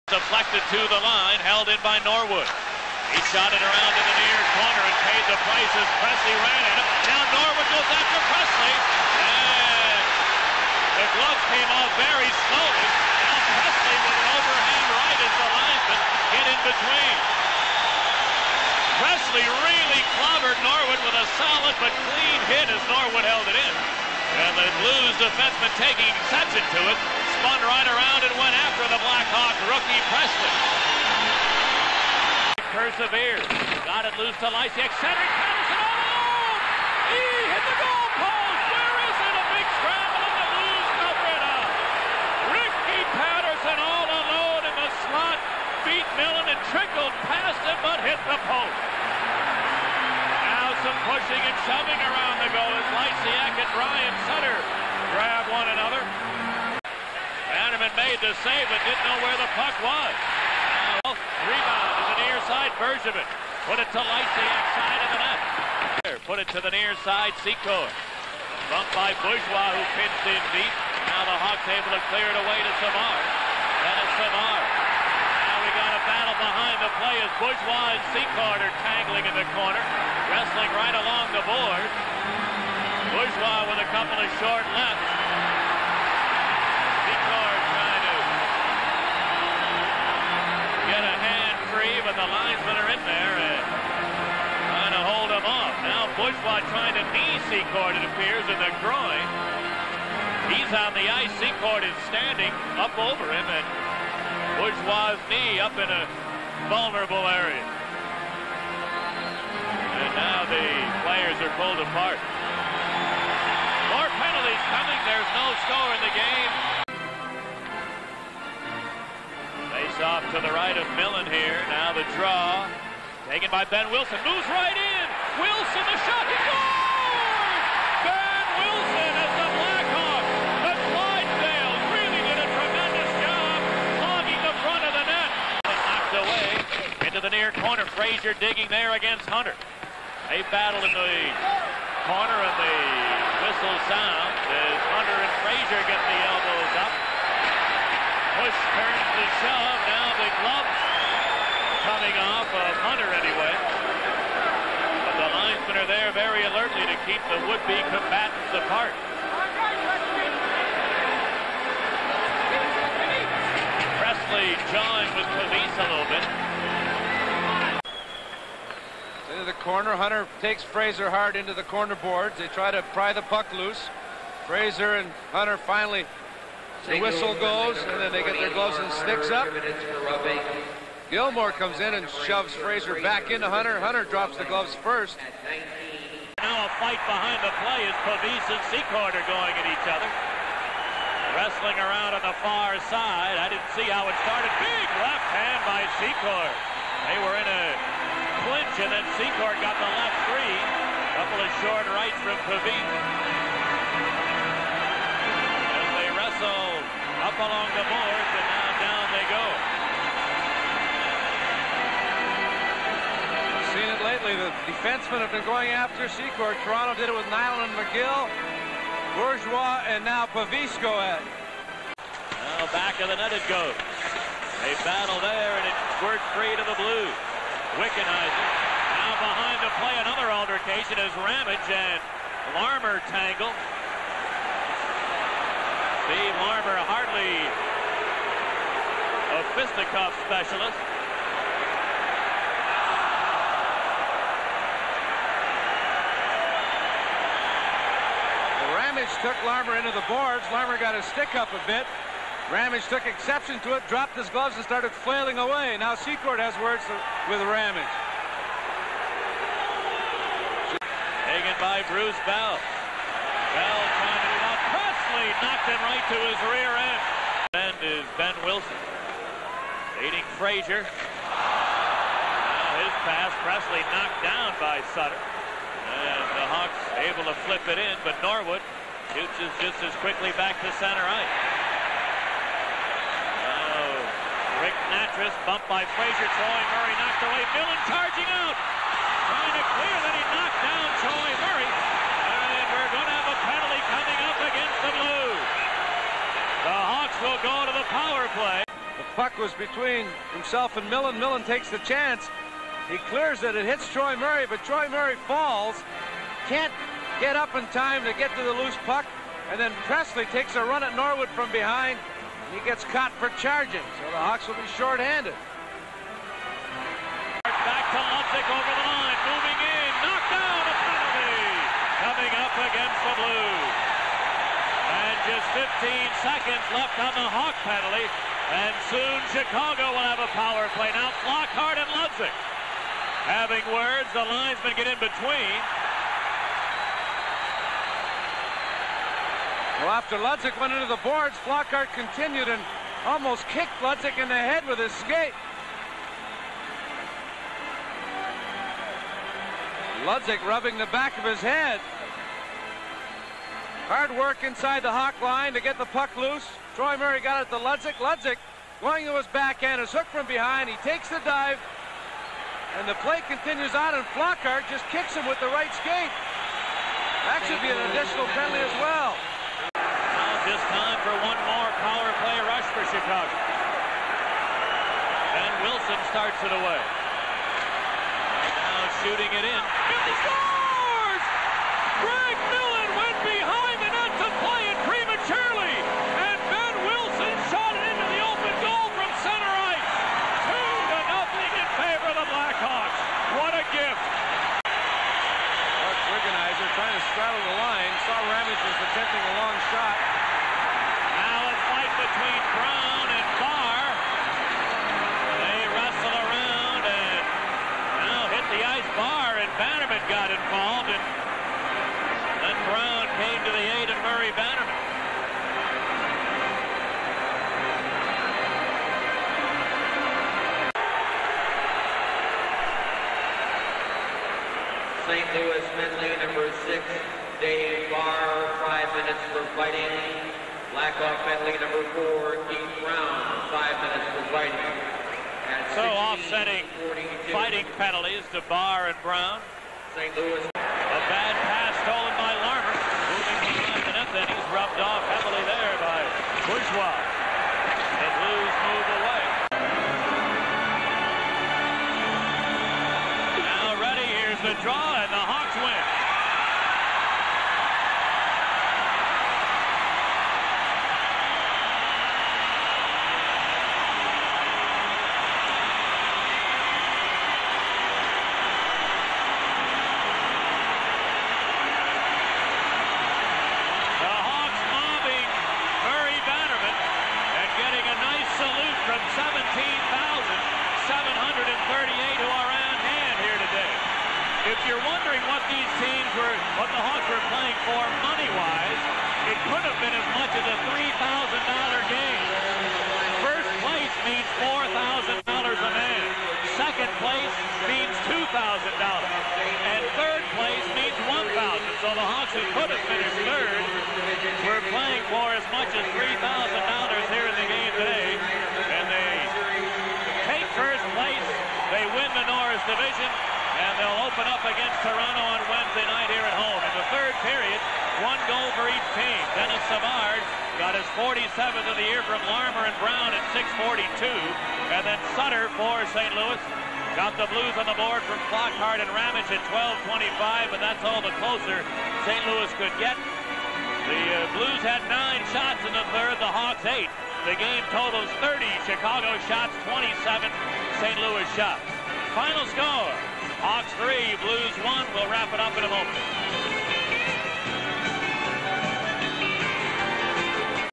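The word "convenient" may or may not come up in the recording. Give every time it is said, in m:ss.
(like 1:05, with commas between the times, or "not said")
not said.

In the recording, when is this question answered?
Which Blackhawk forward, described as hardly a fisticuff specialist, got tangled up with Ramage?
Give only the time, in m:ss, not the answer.
3:56.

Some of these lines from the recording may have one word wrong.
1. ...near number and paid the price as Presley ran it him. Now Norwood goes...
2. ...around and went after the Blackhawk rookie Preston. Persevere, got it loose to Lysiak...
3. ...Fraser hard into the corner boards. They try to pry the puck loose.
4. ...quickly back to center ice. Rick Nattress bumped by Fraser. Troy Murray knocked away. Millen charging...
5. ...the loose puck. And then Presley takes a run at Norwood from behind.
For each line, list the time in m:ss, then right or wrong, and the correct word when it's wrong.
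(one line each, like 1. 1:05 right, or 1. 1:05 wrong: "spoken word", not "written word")
1. 0:04 wrong: "corner", not "number"
2. 0:27 right
3. 2:50 right
4. 4:39 right
5. 5:08 right.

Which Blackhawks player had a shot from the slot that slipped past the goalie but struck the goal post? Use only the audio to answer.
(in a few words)
Ricky Paterson.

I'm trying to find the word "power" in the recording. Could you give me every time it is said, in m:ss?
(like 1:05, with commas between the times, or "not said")
4:57, 5:30, 6:11.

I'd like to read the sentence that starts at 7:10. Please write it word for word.
Blackhawk Medley number four, Keith Brown, five minutes for fighting.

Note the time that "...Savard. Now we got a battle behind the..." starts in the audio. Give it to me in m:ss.
1:14.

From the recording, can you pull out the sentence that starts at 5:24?
And just 15 seconds left on the Hawk penalty.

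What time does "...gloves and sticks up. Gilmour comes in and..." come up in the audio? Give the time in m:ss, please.
2:58.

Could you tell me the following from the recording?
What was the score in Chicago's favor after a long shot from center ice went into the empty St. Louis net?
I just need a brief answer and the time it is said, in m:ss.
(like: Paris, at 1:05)
2-0, at 6:30.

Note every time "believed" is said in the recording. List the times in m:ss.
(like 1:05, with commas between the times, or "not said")
not said.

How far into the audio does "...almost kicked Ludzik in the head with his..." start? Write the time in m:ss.
5:43.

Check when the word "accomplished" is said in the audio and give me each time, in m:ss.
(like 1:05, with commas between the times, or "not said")
not said.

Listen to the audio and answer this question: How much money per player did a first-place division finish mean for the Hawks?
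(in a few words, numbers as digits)
$4,000.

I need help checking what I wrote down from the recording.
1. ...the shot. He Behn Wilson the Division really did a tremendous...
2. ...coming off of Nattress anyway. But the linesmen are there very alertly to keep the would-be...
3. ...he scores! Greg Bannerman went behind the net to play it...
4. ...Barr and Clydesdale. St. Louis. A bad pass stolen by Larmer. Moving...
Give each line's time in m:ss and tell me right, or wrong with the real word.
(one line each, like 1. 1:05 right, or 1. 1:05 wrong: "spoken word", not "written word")
1. 2:05 wrong: "Clydesdale", not "Division"
2. 2:31 wrong: "Hunter", not "Nattress"
3. 6:20 wrong: "Millen", not "Bannerman"
4. 7:18 wrong: "Brown", not "Clydesdale".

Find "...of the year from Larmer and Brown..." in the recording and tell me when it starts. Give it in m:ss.
8:41.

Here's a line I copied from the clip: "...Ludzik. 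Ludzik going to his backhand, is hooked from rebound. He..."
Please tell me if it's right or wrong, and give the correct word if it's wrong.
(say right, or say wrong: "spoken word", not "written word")
wrong: "behind", not "rebound".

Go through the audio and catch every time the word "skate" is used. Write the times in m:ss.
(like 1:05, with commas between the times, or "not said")
5:44, 6:05.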